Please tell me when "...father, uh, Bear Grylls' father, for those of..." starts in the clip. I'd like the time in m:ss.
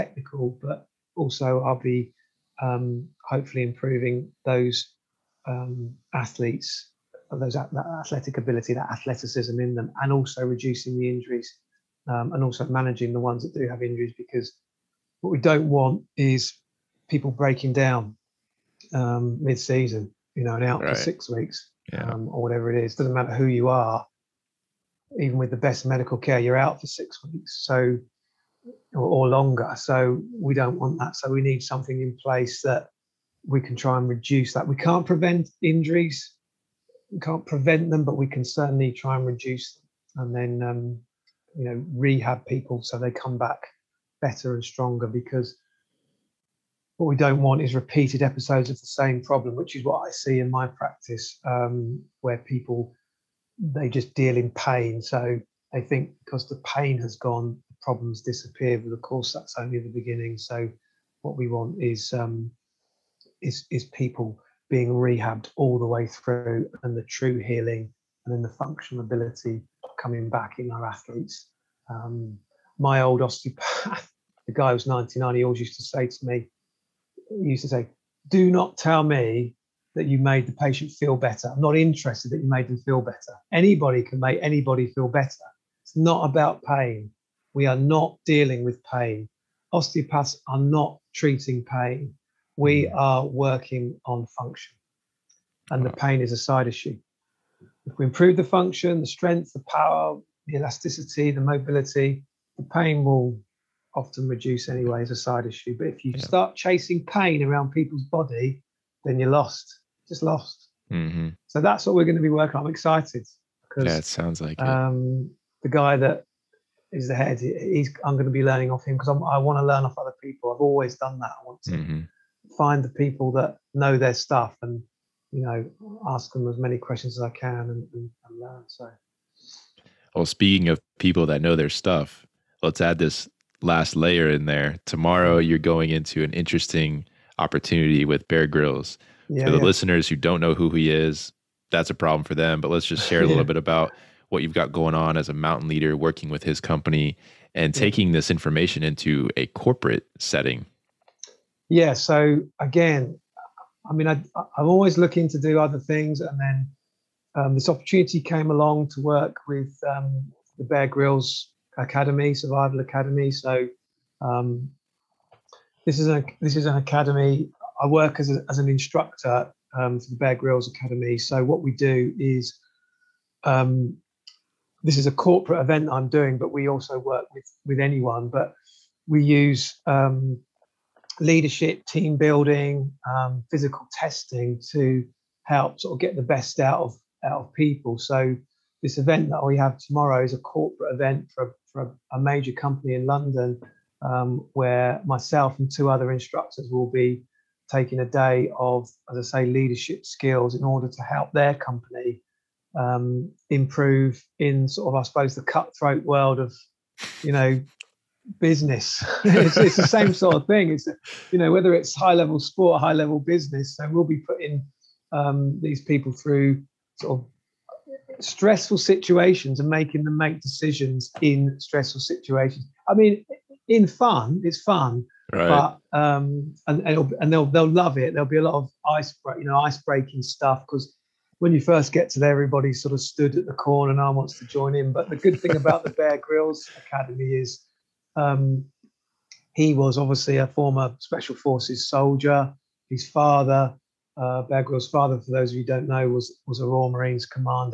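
4:03.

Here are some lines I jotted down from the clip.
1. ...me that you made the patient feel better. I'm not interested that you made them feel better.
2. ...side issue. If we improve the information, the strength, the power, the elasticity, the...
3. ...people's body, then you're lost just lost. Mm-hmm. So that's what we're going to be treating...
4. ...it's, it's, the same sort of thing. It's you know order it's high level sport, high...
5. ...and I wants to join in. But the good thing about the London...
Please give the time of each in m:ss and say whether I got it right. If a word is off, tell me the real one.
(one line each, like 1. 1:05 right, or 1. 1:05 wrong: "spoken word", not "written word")
1. 1:19 right
2. 1:36 wrong: "function", not "information"
3. 1:47 wrong: "working", not "treating"
4. 3:29 wrong: "whether", not "order"
5. 3:53 wrong: "Bear", not "London".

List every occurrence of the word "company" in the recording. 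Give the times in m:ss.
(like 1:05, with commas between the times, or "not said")
2:26, 3:12, 3:21.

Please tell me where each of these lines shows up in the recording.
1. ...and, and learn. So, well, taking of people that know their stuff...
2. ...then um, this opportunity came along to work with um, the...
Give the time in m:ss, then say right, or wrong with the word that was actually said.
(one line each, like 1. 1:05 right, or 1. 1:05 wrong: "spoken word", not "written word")
1. 2:07 wrong: "speaking", not "taking"
2. 2:36 right.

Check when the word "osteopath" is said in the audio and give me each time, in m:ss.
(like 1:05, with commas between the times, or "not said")
1:13, 1:29.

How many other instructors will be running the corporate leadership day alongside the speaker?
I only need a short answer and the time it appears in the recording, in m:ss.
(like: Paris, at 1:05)
2, at 3:15.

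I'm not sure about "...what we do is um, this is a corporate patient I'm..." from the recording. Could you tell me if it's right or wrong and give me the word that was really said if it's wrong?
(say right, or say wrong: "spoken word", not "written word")
wrong: "event", not "patient".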